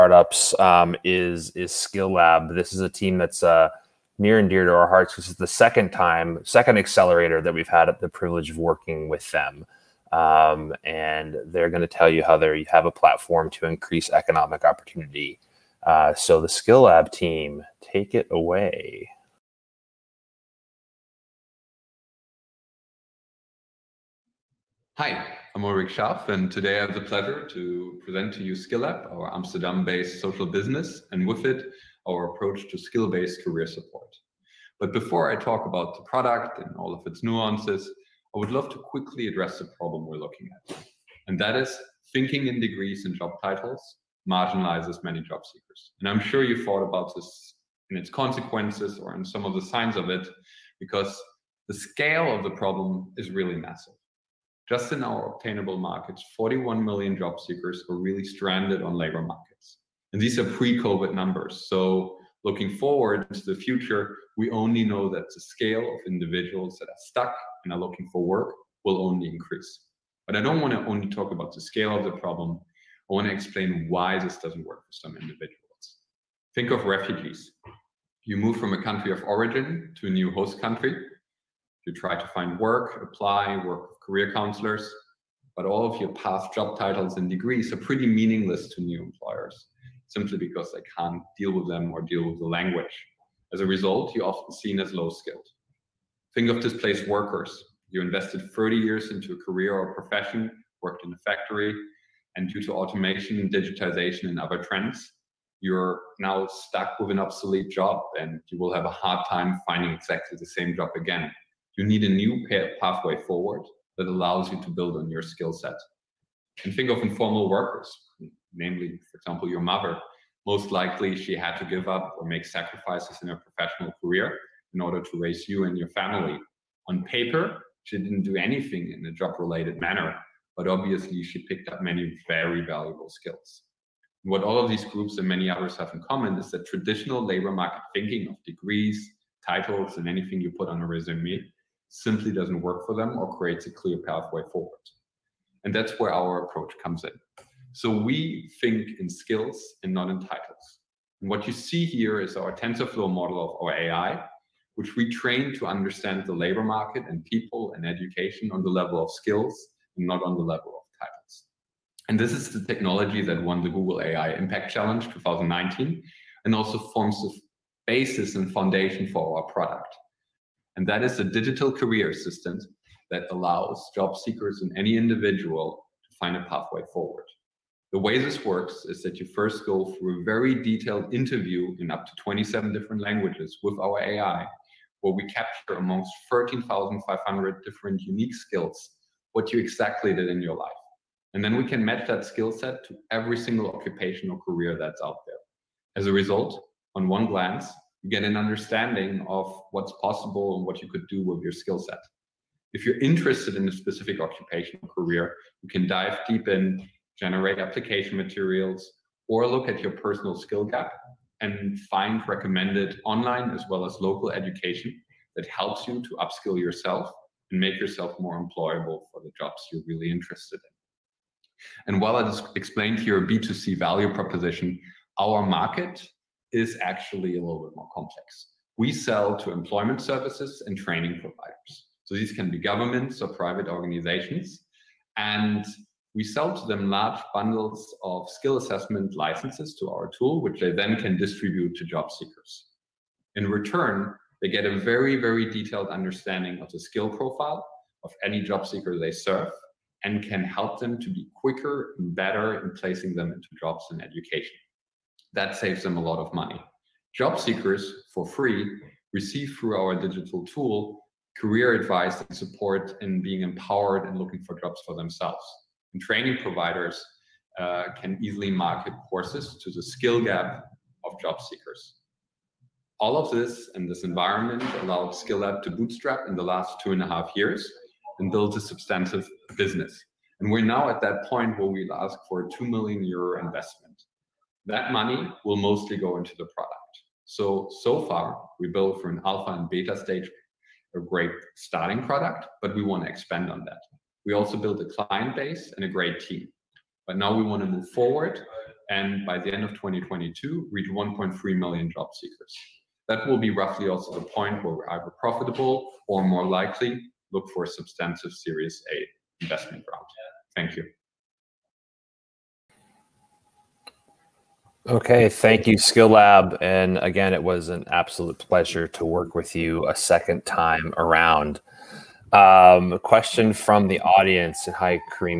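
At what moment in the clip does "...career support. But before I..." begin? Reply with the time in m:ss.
0:33.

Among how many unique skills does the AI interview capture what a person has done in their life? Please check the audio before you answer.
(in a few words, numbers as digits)
13,500.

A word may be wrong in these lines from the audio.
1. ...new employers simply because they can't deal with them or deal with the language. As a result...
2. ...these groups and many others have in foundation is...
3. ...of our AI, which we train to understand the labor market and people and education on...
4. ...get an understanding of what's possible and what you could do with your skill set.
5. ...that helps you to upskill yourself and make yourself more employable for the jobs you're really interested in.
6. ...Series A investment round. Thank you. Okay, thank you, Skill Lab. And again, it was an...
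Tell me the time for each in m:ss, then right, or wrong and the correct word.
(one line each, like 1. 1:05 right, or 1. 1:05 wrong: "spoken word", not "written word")
1. 1:28 right
2. 2:14 wrong: "common", not "foundation"
3. 2:33 right
4. 3:18 right
5. 3:35 right
6. 5:08 right.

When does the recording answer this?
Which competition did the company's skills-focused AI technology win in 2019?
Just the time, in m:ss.
2:43.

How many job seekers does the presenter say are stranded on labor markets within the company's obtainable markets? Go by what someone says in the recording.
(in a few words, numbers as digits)
41 million.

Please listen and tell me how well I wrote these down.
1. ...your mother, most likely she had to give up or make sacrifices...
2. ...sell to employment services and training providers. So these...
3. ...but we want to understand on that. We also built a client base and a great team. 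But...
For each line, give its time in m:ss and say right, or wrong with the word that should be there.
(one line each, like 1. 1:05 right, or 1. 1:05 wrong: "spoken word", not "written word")
1. 1:59 right
2. 3:48 right
3. 4:52 wrong: "expand", not "understand".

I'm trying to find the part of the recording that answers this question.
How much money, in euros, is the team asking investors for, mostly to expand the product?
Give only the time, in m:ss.
4:42.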